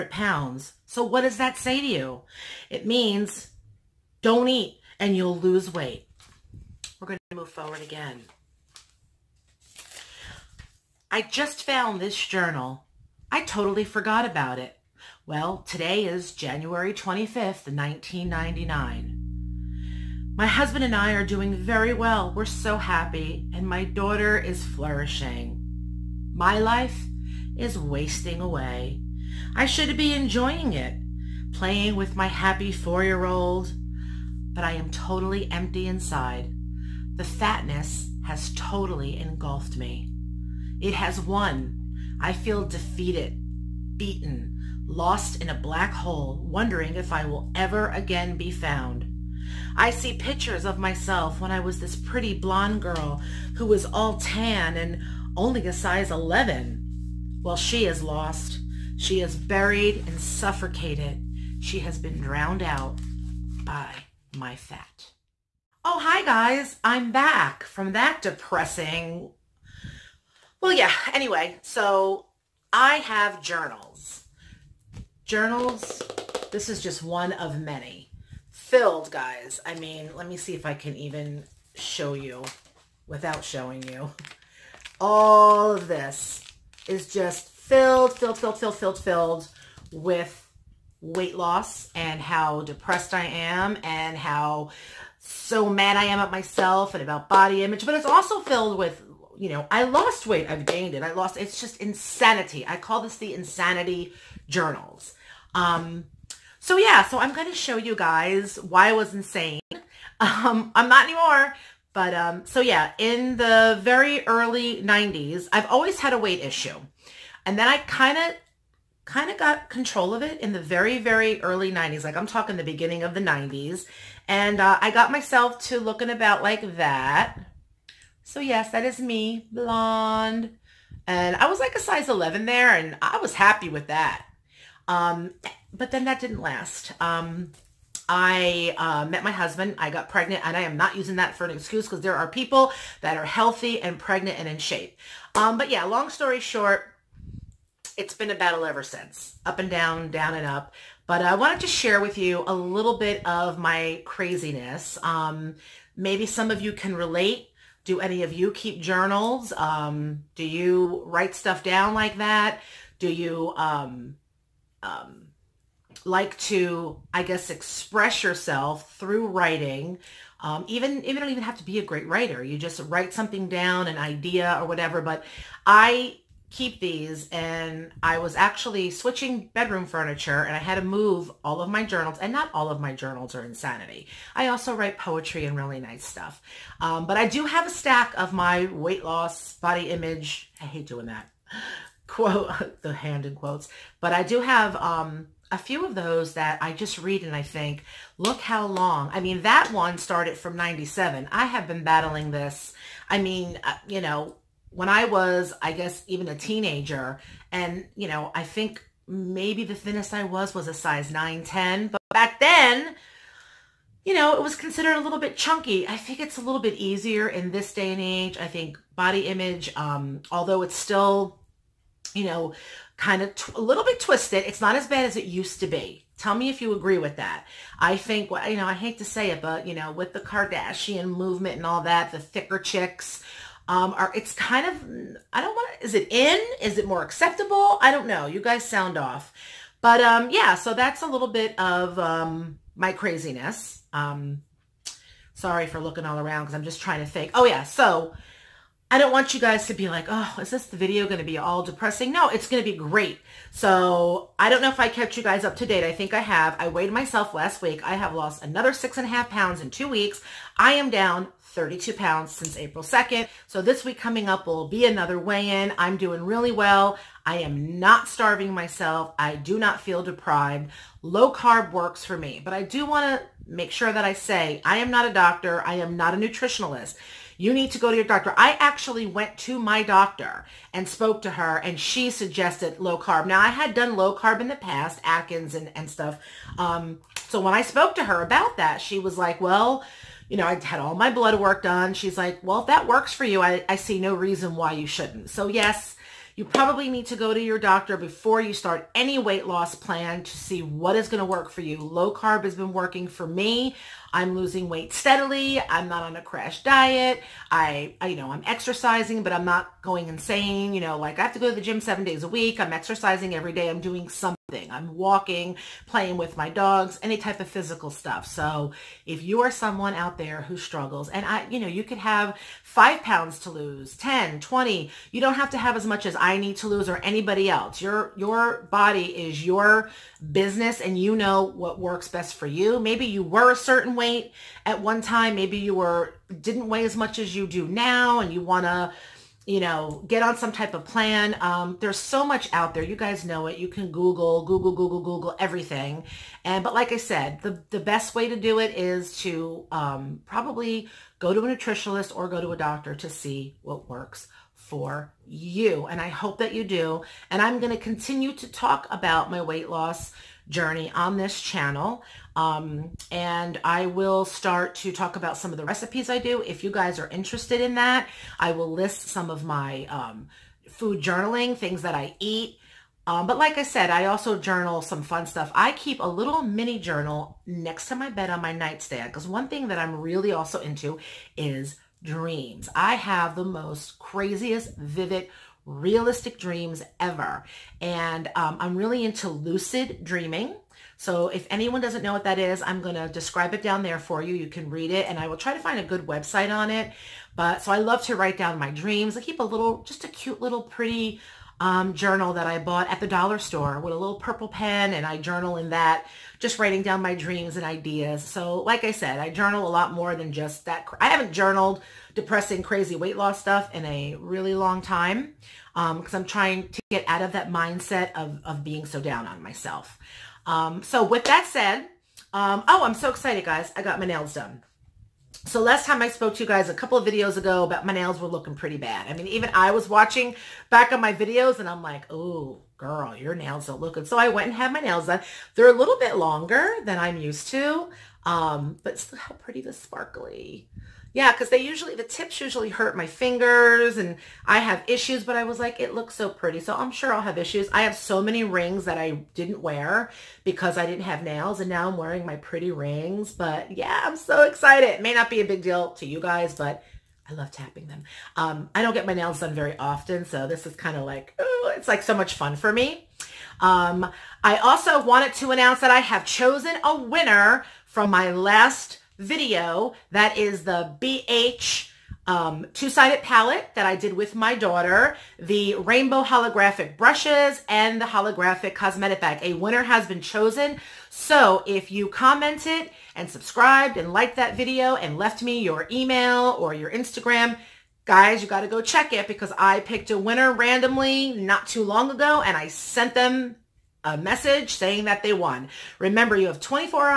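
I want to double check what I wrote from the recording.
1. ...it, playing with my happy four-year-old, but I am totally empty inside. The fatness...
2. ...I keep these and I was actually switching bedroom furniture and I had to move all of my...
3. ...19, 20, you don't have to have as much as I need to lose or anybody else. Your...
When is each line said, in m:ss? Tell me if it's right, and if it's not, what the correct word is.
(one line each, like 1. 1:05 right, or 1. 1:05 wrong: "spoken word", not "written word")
1. 0:30 right
2. 2:55 right
3. 5:23 wrong: "10", not "19".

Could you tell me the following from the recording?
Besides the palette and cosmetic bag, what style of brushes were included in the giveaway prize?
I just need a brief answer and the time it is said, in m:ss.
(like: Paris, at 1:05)
rainbow holographic, at 7:55.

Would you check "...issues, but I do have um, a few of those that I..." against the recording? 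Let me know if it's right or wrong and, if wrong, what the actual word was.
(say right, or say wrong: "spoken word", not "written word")
wrong: "quotes", not "issues".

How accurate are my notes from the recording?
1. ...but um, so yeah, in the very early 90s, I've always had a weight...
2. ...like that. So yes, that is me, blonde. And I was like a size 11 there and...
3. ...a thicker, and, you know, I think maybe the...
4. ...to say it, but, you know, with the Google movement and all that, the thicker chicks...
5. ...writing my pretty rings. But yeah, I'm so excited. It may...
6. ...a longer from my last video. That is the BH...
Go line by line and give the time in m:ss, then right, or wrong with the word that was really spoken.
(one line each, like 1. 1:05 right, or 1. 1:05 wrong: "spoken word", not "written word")
1. 1:51 right
2. 2:06 right
3. 3:26 wrong: "teenager", not "thicker"
4. 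3:48 wrong: "Kardashian", not "Google"
5. 7:31 wrong: "wearing", not "writing"
6. 7:46 wrong: "winner", not "longer".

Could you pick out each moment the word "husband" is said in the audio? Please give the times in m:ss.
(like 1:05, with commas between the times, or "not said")
0:20, 2:19.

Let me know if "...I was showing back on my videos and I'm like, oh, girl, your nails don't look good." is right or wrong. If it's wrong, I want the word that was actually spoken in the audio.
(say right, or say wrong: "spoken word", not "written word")
wrong: "watching", not "showing".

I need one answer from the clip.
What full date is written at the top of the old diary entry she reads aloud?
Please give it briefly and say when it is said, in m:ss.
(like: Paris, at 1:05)
January 25, 1999, at 0:16.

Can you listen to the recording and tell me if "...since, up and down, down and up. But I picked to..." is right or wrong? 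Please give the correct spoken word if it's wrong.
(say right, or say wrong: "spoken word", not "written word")
wrong: "wanted", not "picked".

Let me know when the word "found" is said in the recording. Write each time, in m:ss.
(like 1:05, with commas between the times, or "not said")
0:11, 0:48.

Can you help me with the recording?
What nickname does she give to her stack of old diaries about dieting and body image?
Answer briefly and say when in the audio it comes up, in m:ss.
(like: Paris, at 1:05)
the insanity journals, at 1:43.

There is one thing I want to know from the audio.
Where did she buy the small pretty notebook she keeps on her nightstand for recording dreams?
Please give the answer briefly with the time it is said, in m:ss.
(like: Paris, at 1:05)
the dollar store, at 6:42.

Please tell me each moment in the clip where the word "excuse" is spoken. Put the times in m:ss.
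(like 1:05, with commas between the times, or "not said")
2:21.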